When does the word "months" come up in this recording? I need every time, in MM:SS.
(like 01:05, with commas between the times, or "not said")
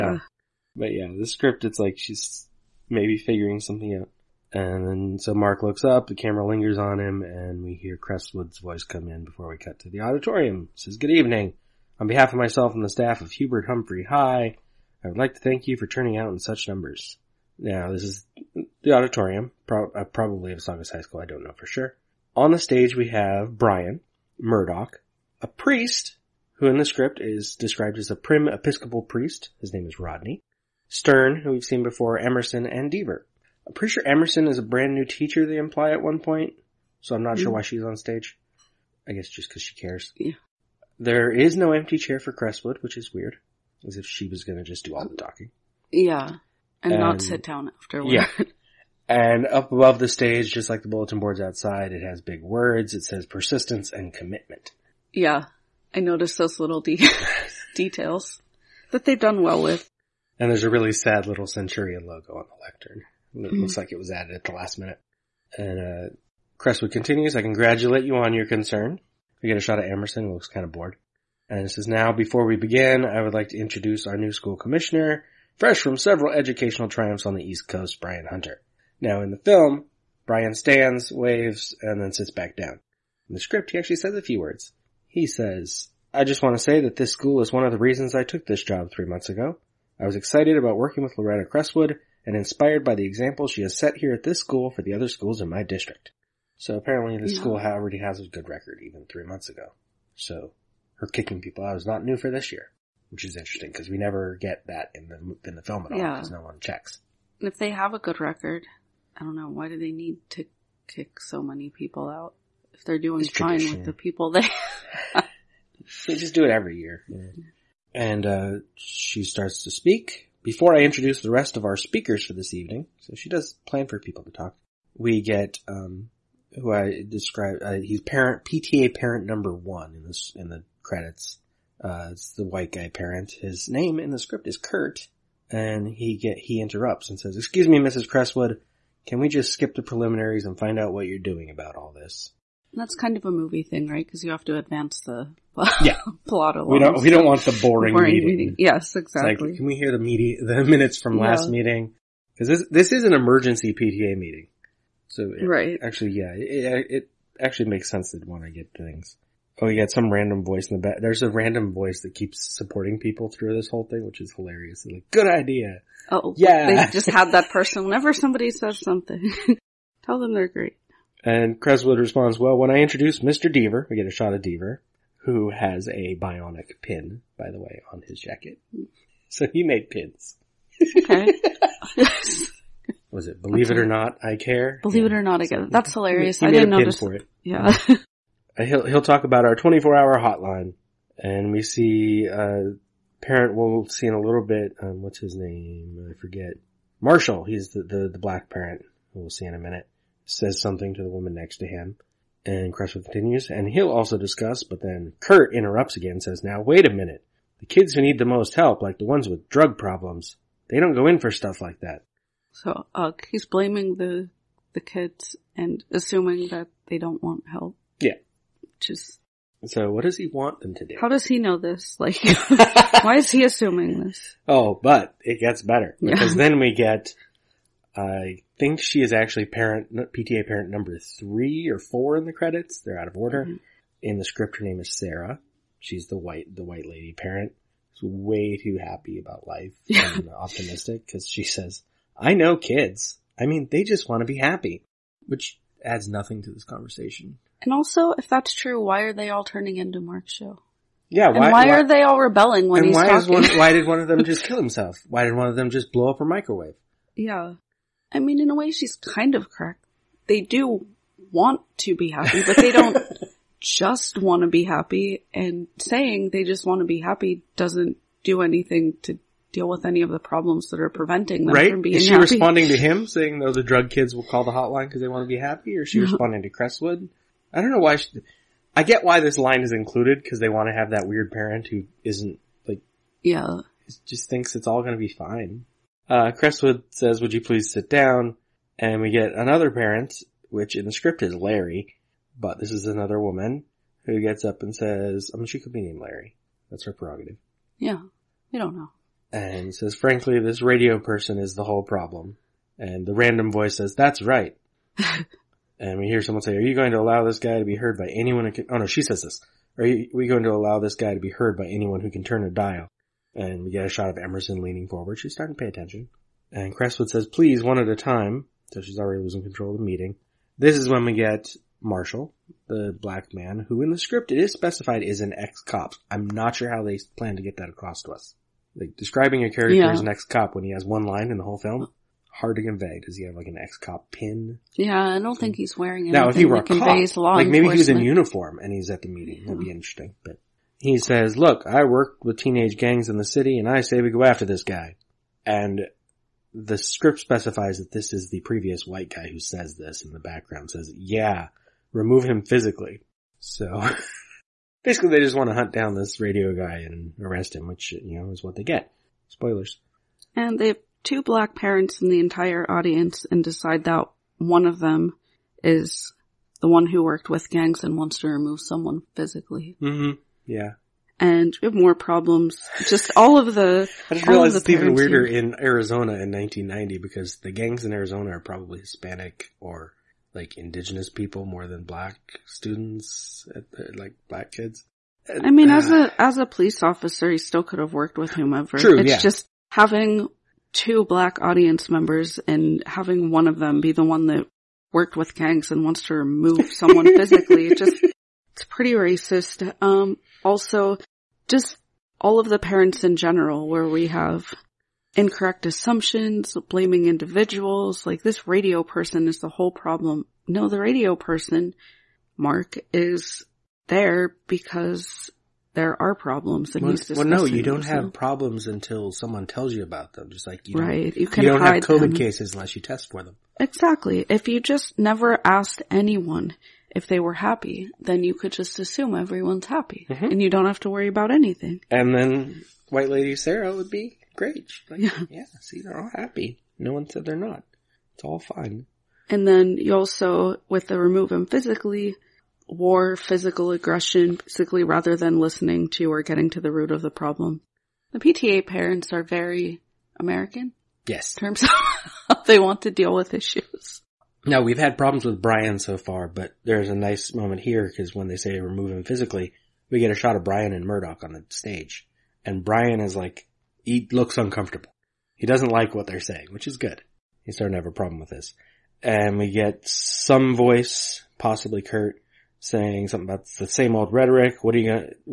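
01:29, 01:39.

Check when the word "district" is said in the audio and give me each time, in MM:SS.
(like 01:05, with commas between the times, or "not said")
01:35.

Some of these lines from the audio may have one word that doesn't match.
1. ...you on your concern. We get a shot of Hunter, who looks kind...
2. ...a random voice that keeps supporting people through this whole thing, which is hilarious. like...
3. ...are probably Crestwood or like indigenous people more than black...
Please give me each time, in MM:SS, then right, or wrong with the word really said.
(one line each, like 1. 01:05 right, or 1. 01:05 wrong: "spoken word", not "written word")
1. 01:08 wrong: "Emerson", not "Hunter"
2. 02:41 right
3. 06:18 wrong: "Hispanic", not "Crestwood".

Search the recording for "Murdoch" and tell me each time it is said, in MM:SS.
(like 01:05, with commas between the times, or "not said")
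00:24, 07:40.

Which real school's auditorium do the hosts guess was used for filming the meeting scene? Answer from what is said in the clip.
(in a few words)
Saugus High School.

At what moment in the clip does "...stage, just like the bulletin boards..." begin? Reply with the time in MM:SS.
00:50.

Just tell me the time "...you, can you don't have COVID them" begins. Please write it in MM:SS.
07:01.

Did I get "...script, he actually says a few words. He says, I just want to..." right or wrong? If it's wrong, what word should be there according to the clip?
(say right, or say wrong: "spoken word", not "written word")
right.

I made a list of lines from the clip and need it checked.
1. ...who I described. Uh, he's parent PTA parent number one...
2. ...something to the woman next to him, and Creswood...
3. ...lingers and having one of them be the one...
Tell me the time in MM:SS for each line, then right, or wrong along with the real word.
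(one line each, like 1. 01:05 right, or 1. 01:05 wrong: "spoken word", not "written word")
1. 02:06 right
2. 03:20 right
3. 06:31 wrong: "members", not "lingers".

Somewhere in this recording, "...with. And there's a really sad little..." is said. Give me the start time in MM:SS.
00:59.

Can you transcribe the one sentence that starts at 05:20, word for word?
This is when we get Marshall, the black man, who in the script it is specified is an ex-cop.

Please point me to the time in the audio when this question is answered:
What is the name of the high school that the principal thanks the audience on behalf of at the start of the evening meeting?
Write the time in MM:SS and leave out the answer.
00:13.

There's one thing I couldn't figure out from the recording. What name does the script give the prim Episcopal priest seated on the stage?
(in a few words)
Rodney.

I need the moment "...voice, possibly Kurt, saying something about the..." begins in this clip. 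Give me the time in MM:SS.
07:50.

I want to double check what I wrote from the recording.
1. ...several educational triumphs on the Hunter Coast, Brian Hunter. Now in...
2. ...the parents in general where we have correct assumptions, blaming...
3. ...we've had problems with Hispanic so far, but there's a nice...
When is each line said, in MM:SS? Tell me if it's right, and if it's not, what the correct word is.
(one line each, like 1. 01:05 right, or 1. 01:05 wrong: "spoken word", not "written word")
1. 01:15 wrong: "East", not "Hunter"
2. 06:42 wrong: "incorrect", not "correct"
3. 07:34 wrong: "Brian", not "Hispanic".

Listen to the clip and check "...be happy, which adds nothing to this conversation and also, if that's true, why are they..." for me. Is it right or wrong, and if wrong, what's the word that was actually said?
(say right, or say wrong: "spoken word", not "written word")
right.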